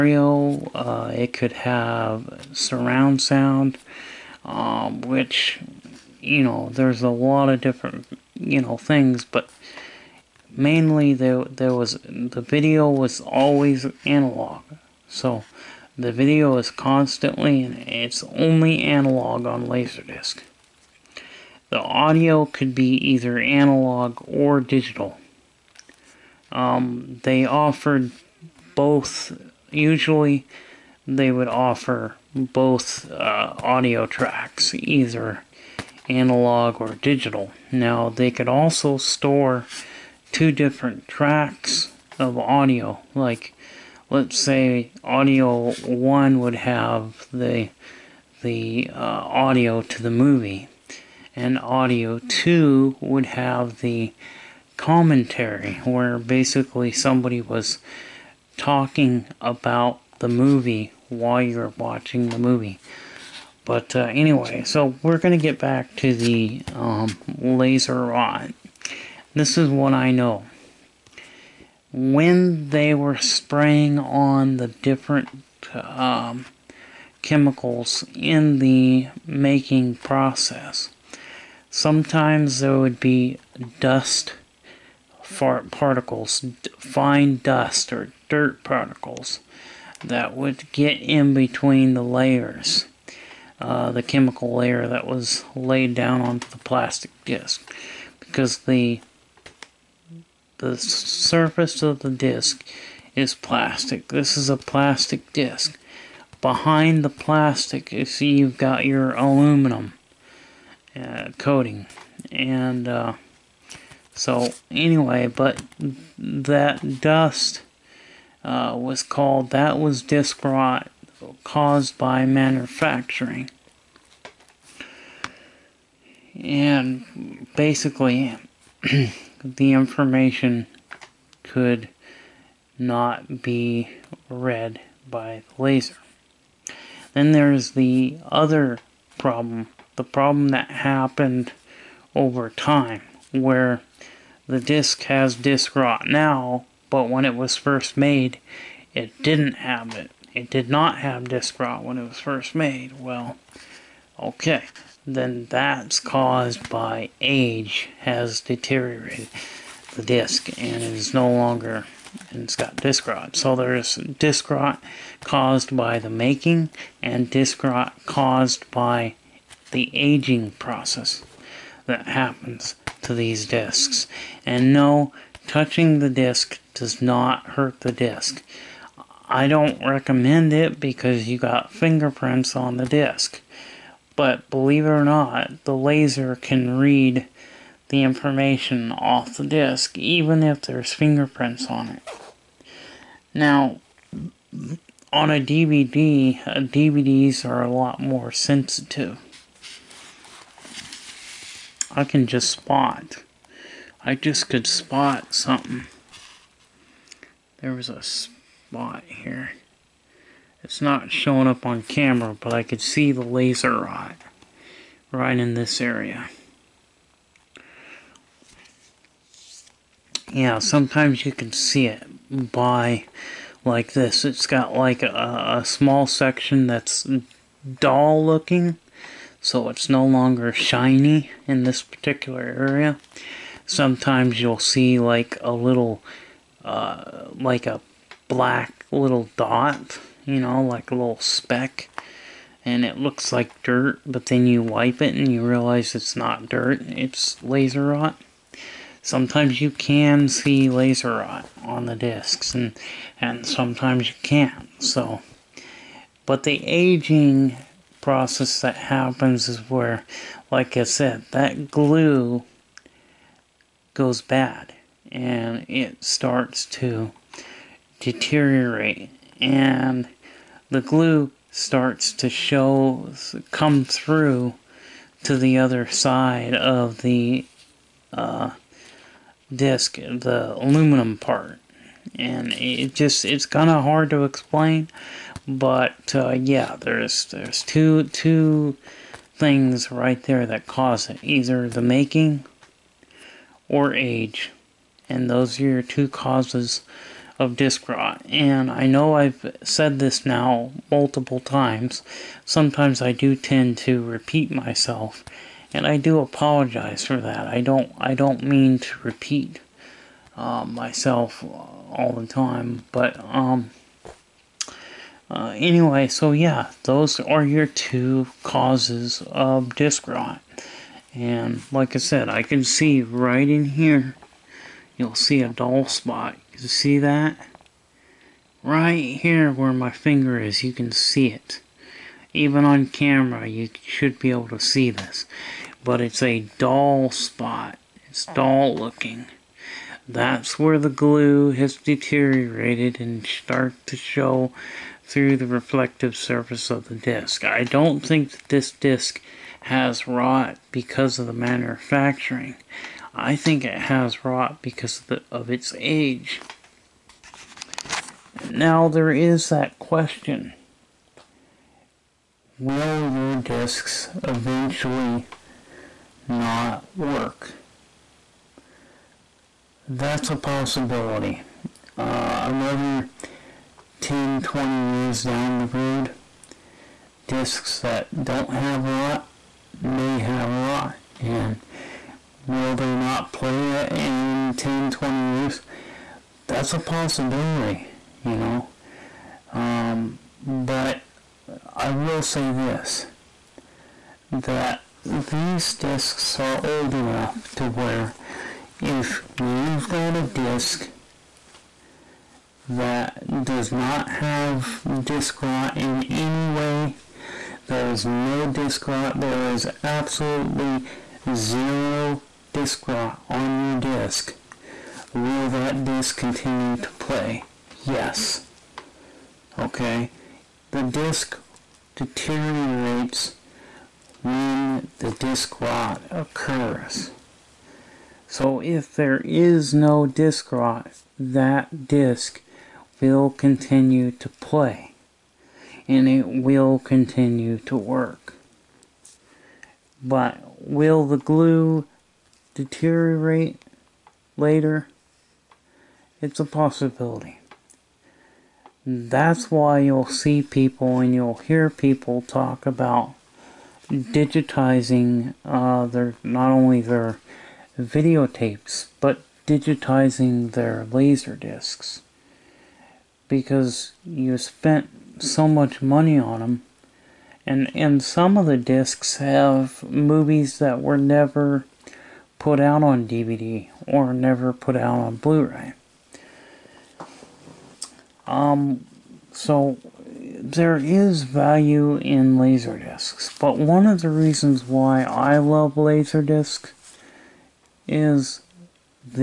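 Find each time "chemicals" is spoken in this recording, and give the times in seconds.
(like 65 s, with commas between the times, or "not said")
77 s, 94 s.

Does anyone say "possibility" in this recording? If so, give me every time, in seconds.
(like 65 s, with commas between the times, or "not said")
370 s, 386 s, 446 s.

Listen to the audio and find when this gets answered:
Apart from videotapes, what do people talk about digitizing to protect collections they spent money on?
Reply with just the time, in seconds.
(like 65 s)
460 s.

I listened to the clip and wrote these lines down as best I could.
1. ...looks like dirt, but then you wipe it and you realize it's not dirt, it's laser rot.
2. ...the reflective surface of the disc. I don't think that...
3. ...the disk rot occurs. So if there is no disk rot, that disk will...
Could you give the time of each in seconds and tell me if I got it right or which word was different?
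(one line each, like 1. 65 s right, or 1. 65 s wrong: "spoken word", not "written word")
1. 242 s right
2. 345 s right
3. 424 s right.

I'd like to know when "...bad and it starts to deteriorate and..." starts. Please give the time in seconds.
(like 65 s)
264 s.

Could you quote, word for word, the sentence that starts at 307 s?
I don't I don't mean to repeat uh, myself all the time, but um.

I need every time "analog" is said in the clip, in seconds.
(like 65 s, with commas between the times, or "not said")
14 s, 18 s, 23 s, 36 s.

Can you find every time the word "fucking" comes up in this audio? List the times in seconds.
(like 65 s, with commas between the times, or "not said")
not said.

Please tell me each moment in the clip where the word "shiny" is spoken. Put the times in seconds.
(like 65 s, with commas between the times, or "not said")
230 s.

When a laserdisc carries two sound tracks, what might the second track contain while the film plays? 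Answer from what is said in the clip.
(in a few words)
the commentary.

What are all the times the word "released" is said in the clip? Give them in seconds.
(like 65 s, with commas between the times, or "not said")
not said.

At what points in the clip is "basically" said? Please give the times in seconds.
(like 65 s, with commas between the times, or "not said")
56 s, 127 s.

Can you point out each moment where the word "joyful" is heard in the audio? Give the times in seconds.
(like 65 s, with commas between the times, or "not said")
not said.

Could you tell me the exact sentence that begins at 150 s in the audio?
It did not have disc rot when it was first made.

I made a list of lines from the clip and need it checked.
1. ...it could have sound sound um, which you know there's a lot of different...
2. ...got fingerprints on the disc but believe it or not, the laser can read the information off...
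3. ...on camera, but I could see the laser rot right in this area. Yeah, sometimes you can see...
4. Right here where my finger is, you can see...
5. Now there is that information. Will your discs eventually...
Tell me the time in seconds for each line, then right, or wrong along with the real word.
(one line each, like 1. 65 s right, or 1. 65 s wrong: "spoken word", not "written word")
1. 1 s wrong: "surround", not "sound"
2. 181 s right
3. 211 s right
4. 328 s right
5. 358 s wrong: "question", not "information".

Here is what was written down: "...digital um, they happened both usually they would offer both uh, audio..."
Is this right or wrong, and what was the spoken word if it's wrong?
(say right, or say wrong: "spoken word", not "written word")
wrong: "offered", not "happened".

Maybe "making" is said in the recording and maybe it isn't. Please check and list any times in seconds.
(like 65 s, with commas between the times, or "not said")
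79 s, 166 s, 291 s.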